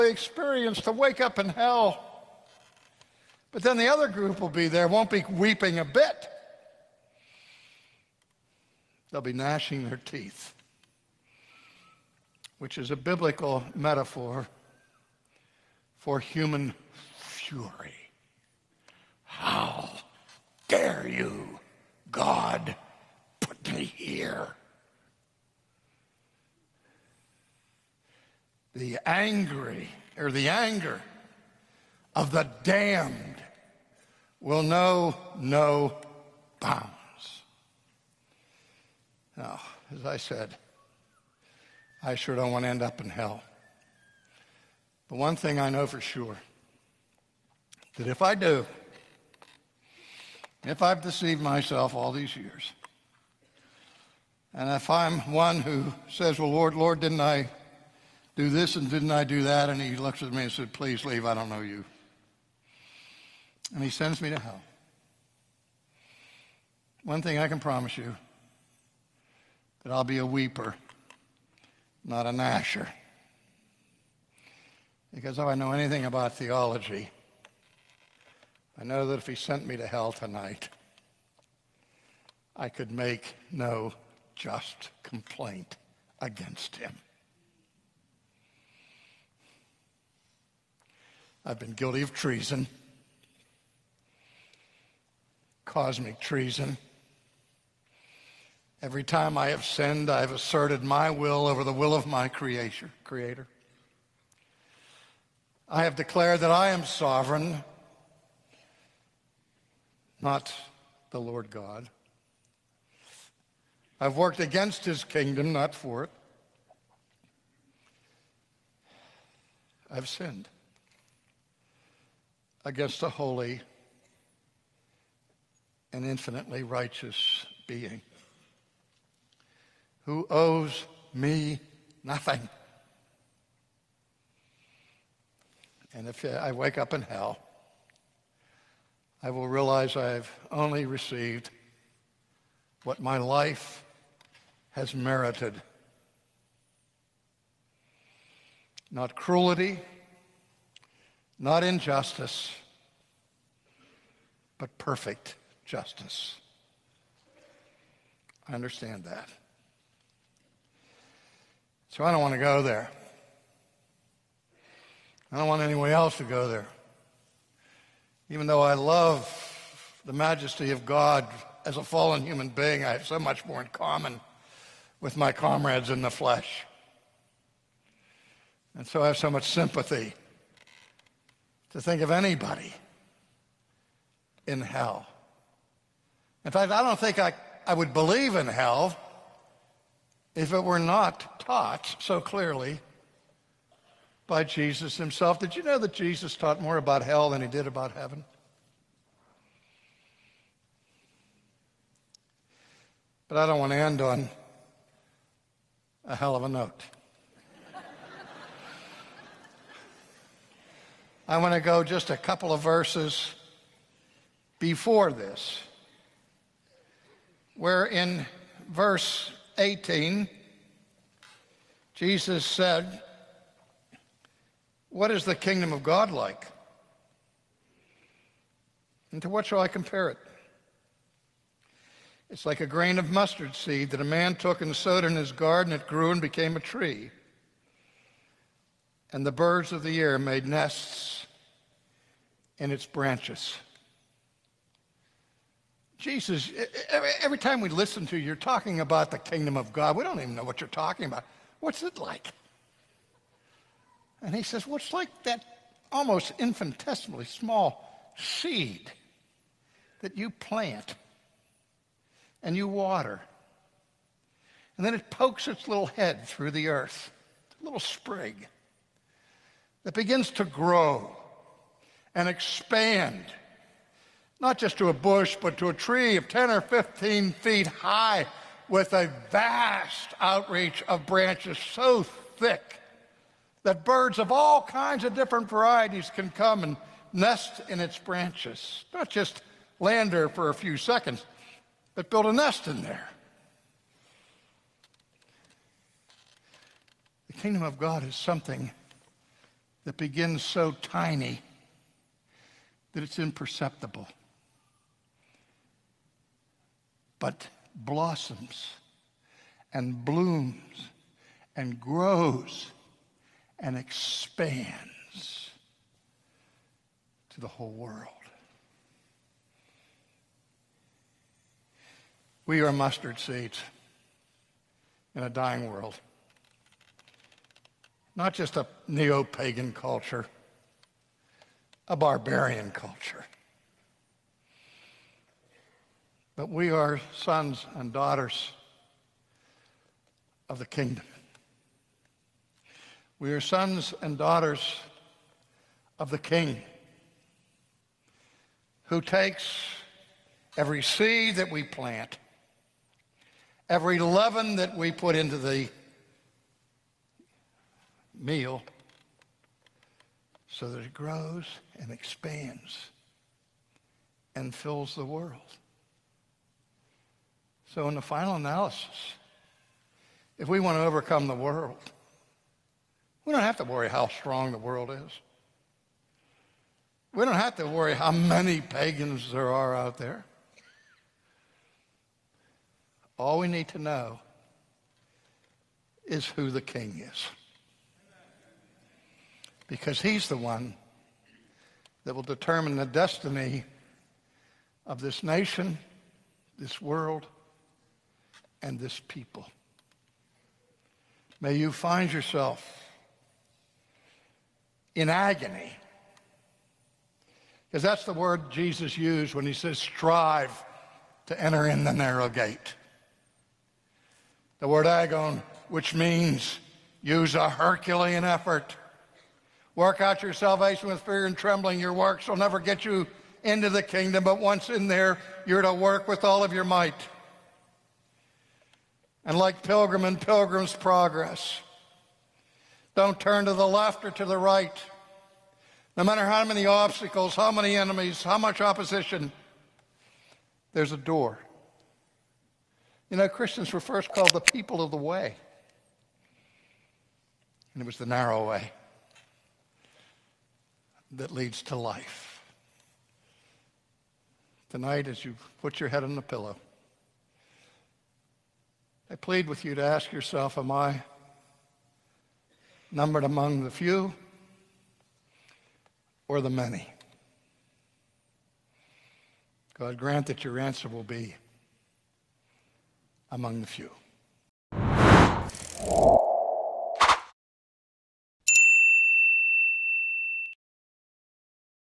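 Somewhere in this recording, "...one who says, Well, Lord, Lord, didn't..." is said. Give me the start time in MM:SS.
00:55.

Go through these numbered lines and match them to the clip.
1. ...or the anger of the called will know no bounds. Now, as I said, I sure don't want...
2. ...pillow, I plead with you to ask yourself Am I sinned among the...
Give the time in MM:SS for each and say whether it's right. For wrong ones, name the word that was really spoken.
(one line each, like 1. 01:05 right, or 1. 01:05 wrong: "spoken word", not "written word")
1. 00:30 wrong: "damned", not "called"
2. 07:36 wrong: "numbered", not "sinned".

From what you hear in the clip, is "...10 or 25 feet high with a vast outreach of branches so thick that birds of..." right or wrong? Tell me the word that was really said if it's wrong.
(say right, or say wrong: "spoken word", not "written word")
wrong: "15", not "25".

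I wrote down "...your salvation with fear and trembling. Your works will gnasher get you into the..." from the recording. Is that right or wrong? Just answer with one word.
wrong.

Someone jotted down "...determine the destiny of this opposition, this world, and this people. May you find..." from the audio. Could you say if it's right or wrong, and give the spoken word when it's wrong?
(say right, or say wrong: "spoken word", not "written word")
wrong: "nation", not "opposition".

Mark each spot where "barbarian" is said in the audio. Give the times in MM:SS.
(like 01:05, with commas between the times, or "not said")
05:31.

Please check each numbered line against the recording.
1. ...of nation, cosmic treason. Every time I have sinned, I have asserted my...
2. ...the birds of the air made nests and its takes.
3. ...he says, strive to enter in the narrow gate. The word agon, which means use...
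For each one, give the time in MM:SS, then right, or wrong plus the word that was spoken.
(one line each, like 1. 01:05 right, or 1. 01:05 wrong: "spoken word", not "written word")
1. 01:32 wrong: "treason", not "nation"
2. 03:59 wrong: "branches", not "takes"
3. 06:49 right.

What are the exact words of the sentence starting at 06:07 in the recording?
So, in the final analysis, if we want to overcome the world, we don't have to worry how strong the world is.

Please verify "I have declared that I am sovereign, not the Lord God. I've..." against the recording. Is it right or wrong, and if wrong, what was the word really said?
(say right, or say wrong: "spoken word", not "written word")
right.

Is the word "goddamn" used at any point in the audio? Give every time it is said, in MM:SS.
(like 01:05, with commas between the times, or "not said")
not said.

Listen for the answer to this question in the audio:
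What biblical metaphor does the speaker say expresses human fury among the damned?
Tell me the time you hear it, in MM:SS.
00:09.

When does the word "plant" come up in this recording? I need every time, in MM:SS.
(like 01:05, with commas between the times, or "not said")
04:20, 05:51.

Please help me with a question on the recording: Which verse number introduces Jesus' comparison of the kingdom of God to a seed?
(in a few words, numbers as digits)
18.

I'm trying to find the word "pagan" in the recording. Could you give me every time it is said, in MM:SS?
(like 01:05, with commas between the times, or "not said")
05:29, 06:18.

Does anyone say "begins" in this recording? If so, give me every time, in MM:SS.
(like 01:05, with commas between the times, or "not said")
04:29, 04:59.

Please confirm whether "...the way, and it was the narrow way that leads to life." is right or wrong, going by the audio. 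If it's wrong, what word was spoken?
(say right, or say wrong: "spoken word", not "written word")
right.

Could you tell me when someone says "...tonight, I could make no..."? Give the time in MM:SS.
01:20.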